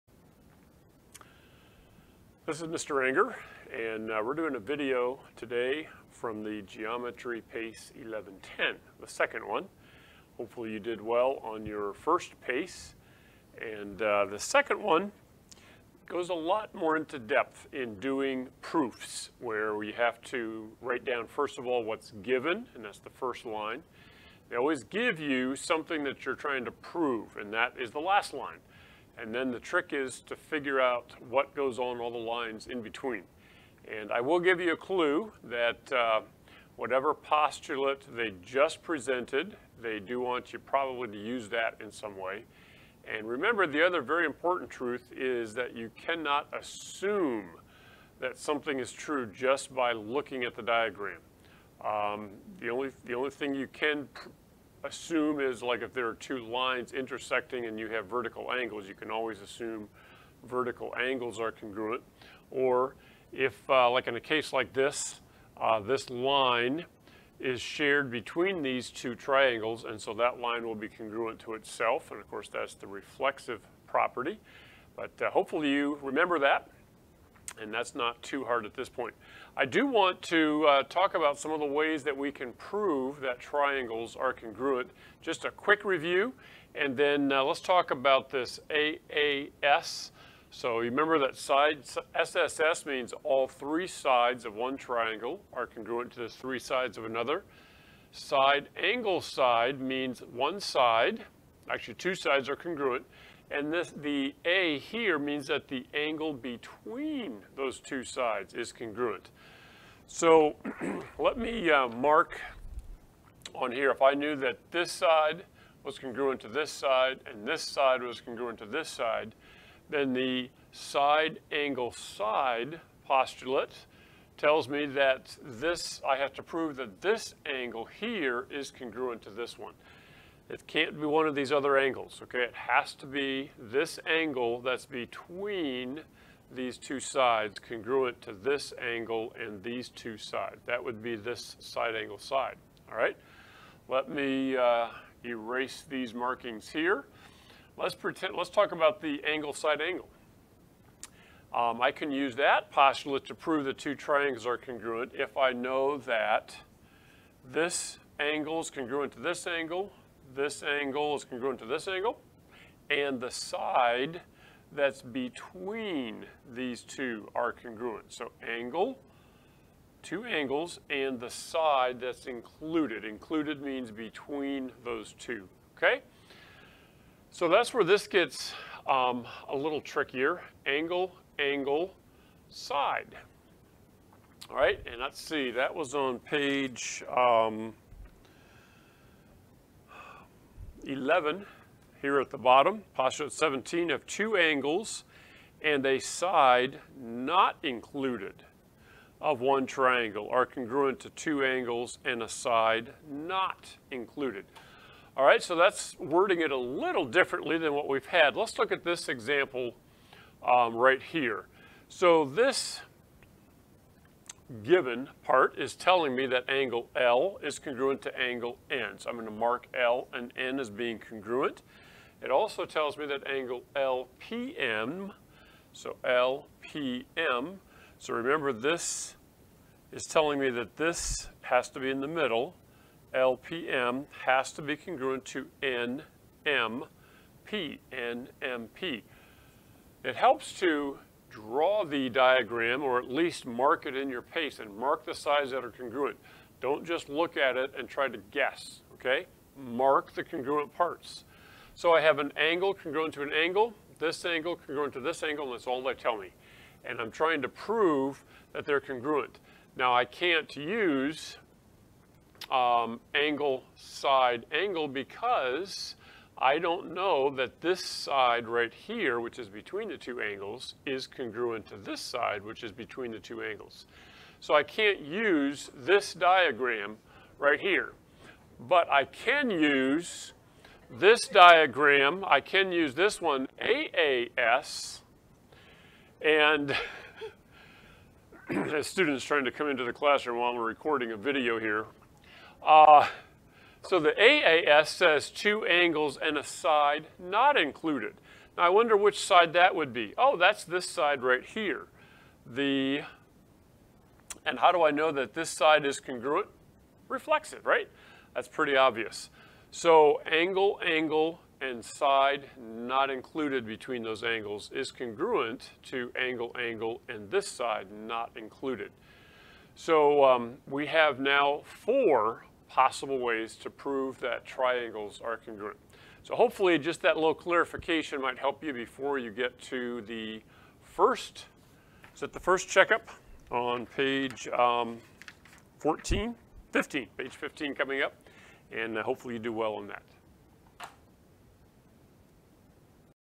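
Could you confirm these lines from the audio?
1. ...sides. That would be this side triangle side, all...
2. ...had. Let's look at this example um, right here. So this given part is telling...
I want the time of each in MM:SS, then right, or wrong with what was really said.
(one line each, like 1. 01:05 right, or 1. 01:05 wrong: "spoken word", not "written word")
1. 02:20 wrong: "angle", not "triangle"
2. 03:28 right.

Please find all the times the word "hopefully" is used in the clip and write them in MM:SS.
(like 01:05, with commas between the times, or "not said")
00:10, 01:15, 05:26, 05:39.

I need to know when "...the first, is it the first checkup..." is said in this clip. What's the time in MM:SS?
05:30.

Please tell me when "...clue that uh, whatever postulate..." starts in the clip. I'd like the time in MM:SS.
00:34.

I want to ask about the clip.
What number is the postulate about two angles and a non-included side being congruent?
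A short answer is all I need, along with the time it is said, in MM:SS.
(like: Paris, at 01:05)
17, at 03:13.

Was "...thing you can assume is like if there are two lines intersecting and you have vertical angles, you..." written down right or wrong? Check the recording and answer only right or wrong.
right.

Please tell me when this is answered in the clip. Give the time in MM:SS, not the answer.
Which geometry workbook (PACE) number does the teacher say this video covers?
00:07.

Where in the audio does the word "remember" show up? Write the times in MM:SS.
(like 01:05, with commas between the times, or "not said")
00:43, 01:16, 01:30, 03:48.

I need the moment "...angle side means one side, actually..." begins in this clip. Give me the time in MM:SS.
01:38.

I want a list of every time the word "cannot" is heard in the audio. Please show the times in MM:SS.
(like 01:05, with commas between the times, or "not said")
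00:45.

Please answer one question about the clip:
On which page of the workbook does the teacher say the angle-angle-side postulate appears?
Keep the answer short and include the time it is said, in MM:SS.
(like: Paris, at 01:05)
11, at 03:10.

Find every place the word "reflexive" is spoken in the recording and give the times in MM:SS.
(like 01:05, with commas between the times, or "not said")
01:12, 05:07.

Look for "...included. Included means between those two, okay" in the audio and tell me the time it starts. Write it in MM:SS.
02:52.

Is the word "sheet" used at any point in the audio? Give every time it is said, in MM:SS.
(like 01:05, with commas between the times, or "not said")
not said.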